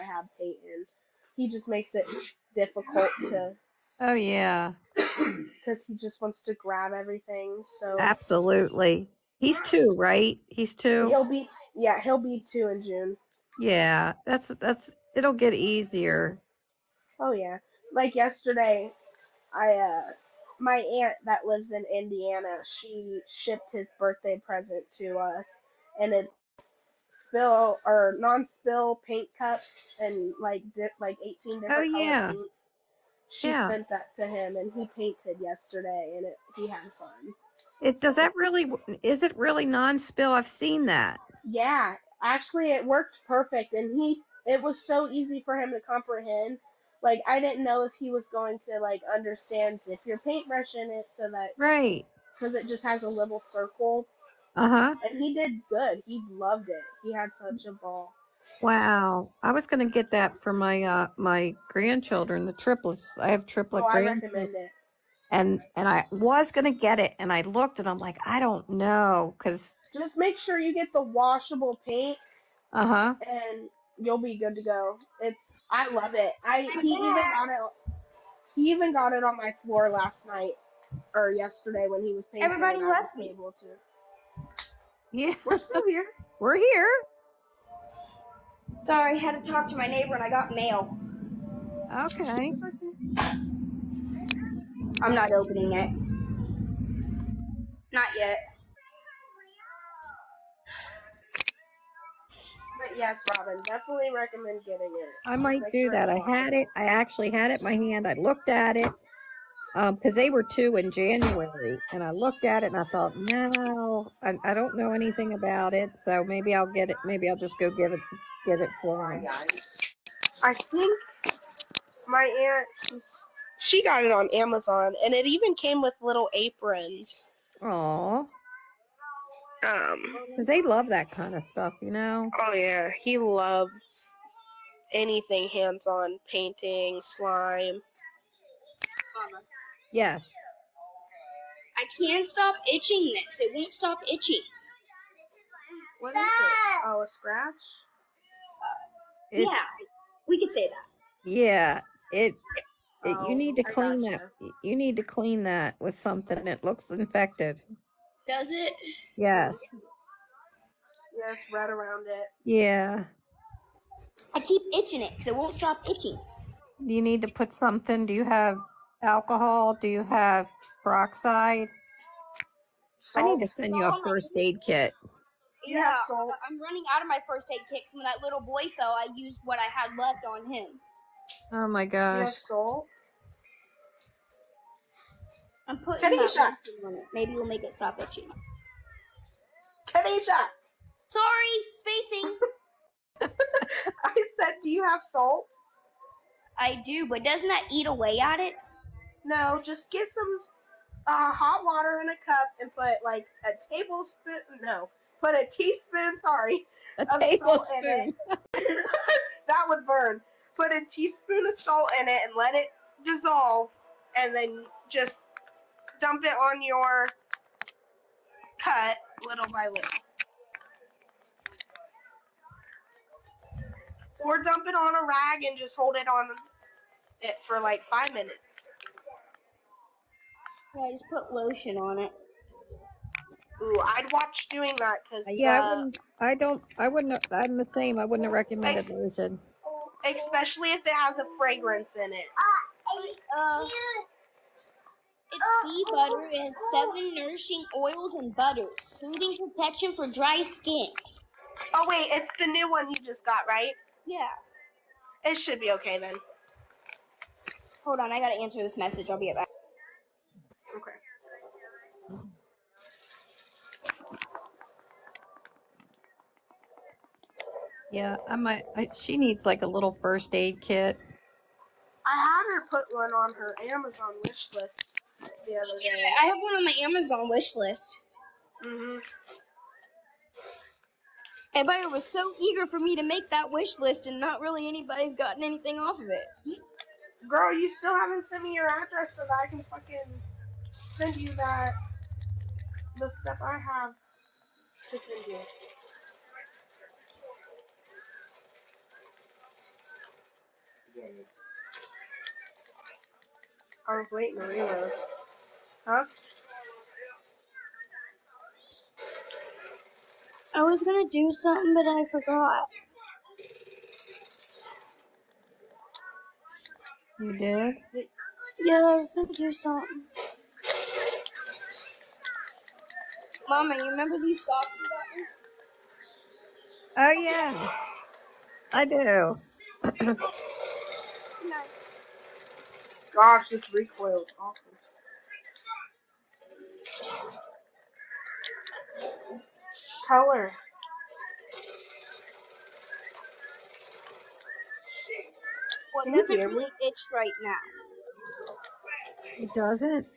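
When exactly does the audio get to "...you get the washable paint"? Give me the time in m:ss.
1:10.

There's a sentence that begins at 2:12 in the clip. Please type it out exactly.
Oh yeah, he loves anything hands-on, painting, slime.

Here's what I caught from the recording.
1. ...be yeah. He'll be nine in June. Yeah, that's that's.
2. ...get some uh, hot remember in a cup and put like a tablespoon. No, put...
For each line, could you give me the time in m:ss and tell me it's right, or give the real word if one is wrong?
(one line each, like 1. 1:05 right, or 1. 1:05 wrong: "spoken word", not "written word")
1. 0:11 wrong: "two", not "nine"
2. 3:19 wrong: "water", not "remember".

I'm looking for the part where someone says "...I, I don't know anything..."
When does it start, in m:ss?
1:54.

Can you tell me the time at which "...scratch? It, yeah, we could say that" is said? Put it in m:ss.
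2:27.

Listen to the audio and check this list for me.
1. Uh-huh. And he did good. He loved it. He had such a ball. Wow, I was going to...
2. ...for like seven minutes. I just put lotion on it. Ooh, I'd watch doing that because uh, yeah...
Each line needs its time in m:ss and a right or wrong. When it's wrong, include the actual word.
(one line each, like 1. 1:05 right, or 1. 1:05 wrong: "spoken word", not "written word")
1. 0:54 right
2. 3:47 wrong: "five", not "seven".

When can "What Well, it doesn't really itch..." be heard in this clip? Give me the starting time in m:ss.
5:45.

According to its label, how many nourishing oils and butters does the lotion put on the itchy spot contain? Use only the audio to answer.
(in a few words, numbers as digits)
7.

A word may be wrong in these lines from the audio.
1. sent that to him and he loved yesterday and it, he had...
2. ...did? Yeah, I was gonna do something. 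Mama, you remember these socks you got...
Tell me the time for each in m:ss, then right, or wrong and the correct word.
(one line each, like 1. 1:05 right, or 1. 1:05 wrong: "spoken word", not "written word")
1. 0:33 wrong: "painted", not "loved"
2. 5:17 right.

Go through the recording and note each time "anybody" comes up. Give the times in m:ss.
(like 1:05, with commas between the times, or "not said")
4:44.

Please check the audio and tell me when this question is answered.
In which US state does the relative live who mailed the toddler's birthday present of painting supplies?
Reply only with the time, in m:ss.
0:21.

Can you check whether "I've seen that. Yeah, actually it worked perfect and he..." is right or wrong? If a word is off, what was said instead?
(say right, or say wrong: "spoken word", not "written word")
right.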